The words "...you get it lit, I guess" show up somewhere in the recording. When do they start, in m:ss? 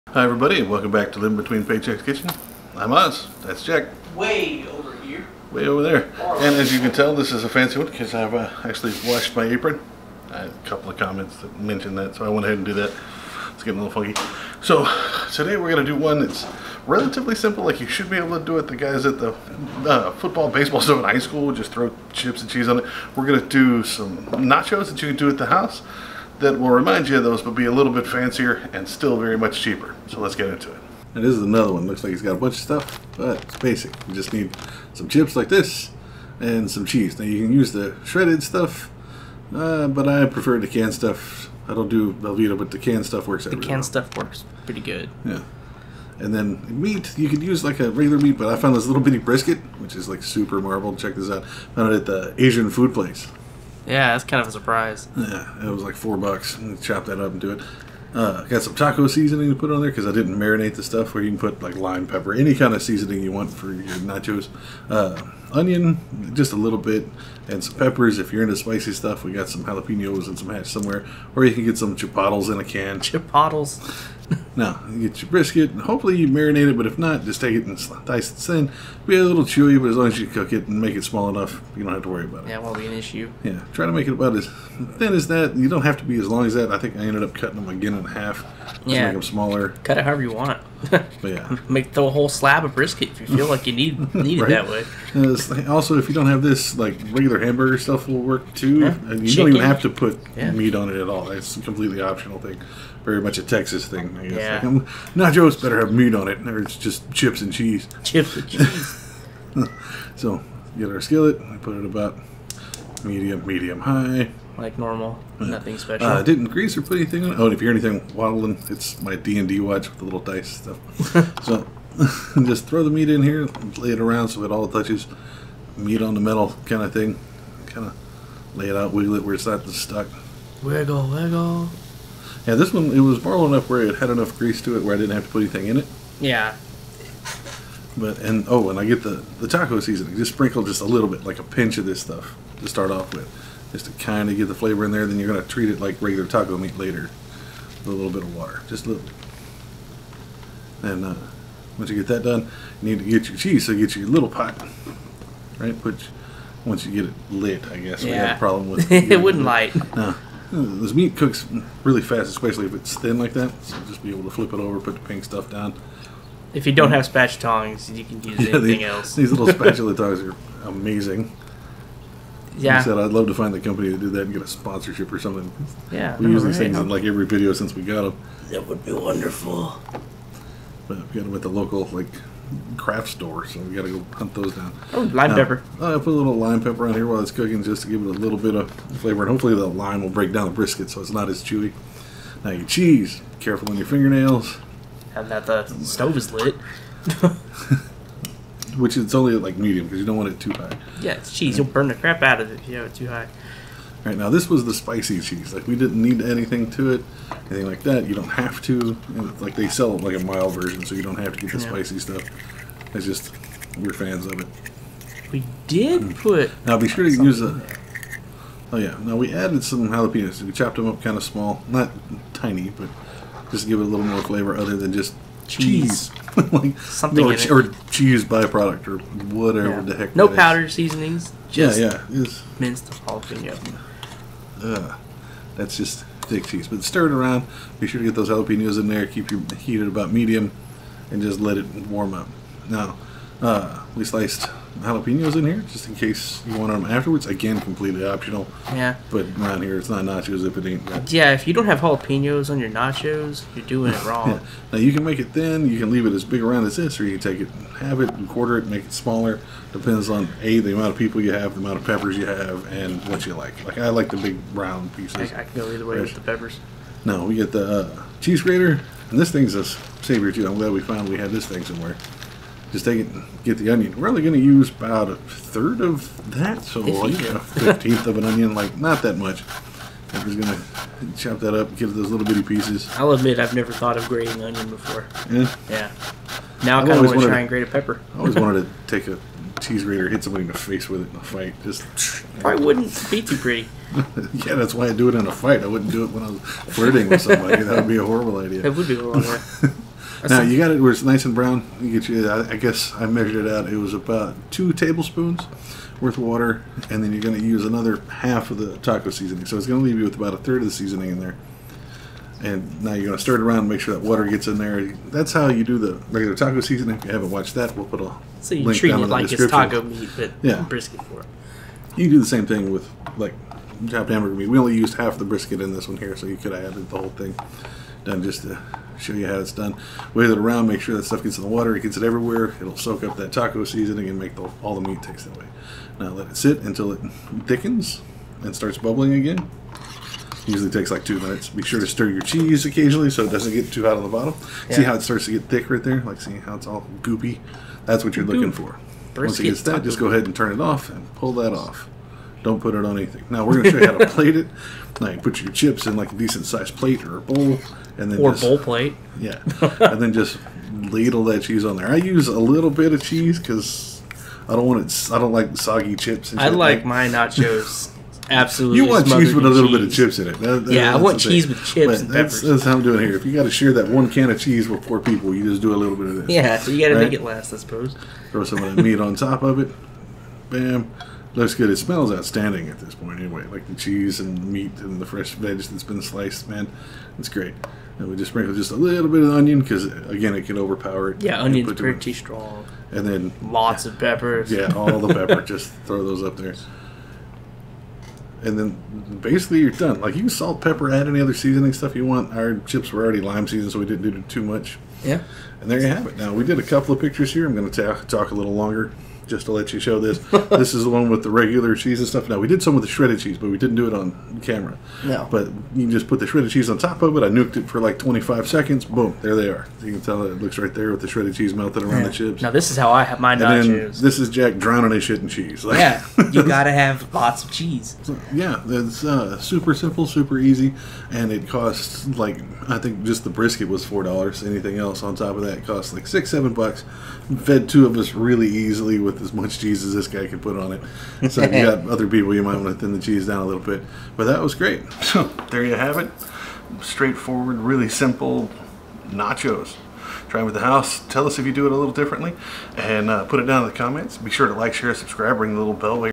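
2:36.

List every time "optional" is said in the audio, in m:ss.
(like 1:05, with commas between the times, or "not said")
1:42, 4:08.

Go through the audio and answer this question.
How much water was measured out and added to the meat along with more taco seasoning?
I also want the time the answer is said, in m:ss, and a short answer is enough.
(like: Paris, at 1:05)
2 tablespoons, at 5:04.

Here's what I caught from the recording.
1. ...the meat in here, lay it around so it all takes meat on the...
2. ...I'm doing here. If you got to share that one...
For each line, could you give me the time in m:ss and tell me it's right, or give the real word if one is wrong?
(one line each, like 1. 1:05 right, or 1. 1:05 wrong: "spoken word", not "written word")
1. 2:02 wrong: "touches", not "takes"
2. 6:12 right.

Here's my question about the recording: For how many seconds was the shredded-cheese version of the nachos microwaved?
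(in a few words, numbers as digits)
25.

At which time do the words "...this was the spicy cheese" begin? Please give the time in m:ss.
3:24.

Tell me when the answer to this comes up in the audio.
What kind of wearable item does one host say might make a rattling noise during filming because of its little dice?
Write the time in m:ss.
1:59.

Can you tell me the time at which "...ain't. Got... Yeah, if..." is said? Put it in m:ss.
4:10.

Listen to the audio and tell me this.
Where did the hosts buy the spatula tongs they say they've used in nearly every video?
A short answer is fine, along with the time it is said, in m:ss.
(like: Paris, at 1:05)
craft store, at 3:02.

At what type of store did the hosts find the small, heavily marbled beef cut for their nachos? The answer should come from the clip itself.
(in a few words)
Asian food place.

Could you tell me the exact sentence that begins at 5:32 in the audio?
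It'll soak up that taco seasoning and make the, all the meat taste that way.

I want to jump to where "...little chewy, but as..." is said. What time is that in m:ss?
1:19.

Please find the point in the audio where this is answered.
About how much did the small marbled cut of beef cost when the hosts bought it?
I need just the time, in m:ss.
0:55.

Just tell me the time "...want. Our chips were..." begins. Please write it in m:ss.
6:42.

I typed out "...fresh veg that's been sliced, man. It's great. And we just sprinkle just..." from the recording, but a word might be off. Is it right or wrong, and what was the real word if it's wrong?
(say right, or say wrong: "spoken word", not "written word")
right.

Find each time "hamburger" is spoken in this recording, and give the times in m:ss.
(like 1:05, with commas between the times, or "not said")
1:37, 5:24.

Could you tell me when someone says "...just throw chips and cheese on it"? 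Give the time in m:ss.
0:21.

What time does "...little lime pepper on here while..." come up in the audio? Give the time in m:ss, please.
3:06.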